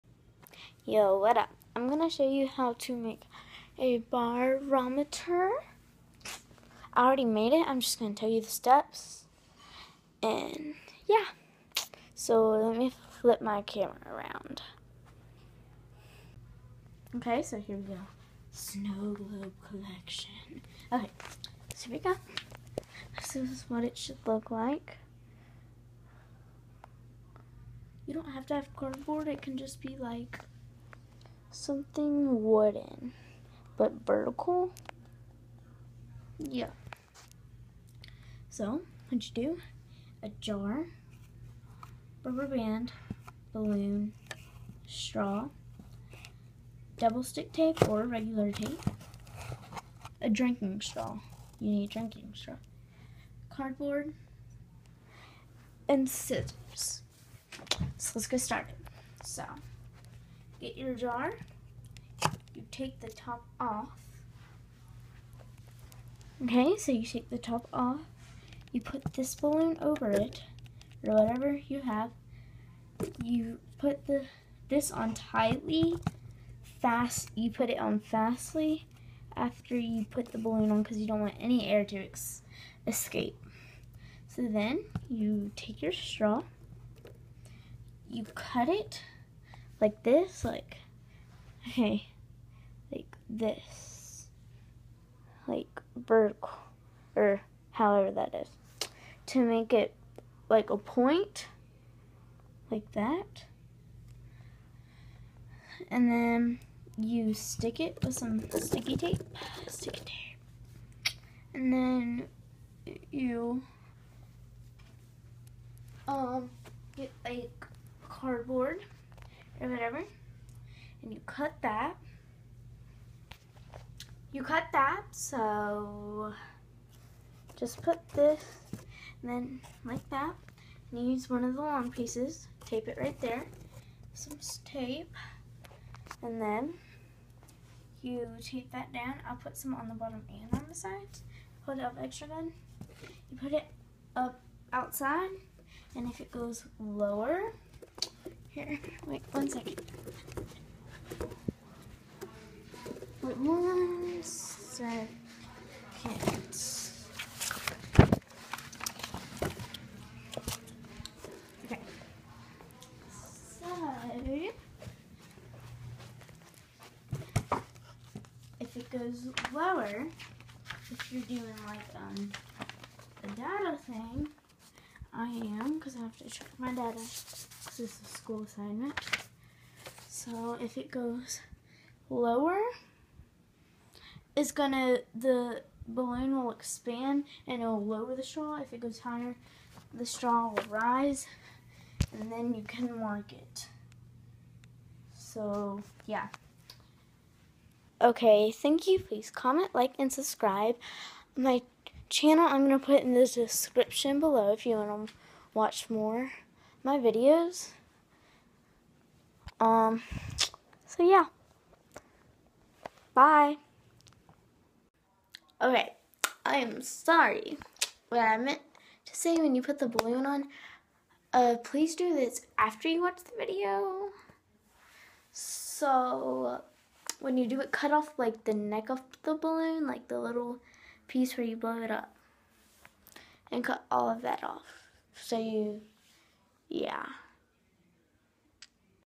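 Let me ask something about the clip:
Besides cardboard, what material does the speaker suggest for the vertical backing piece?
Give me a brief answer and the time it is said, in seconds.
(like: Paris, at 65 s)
something wooden, at 31 s.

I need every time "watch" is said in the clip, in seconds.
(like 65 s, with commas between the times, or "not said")
205 s, 223 s.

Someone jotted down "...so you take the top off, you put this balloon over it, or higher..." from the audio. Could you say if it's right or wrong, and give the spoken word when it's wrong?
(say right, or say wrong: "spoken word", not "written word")
wrong: "whatever", not "higher".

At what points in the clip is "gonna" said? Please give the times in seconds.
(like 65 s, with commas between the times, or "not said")
1 s, 7 s, 184 s.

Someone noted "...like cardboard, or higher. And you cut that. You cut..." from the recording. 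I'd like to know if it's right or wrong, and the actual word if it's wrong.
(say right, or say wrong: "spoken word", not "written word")
wrong: "whatever", not "higher".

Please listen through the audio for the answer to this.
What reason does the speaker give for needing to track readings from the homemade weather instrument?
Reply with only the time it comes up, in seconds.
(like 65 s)
178 s.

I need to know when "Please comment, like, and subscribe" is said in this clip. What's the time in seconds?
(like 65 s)
198 s.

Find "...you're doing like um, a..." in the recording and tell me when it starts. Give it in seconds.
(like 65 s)
171 s.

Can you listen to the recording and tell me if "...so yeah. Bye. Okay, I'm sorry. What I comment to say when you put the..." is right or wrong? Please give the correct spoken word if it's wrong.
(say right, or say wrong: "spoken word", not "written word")
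wrong: "meant", not "comment".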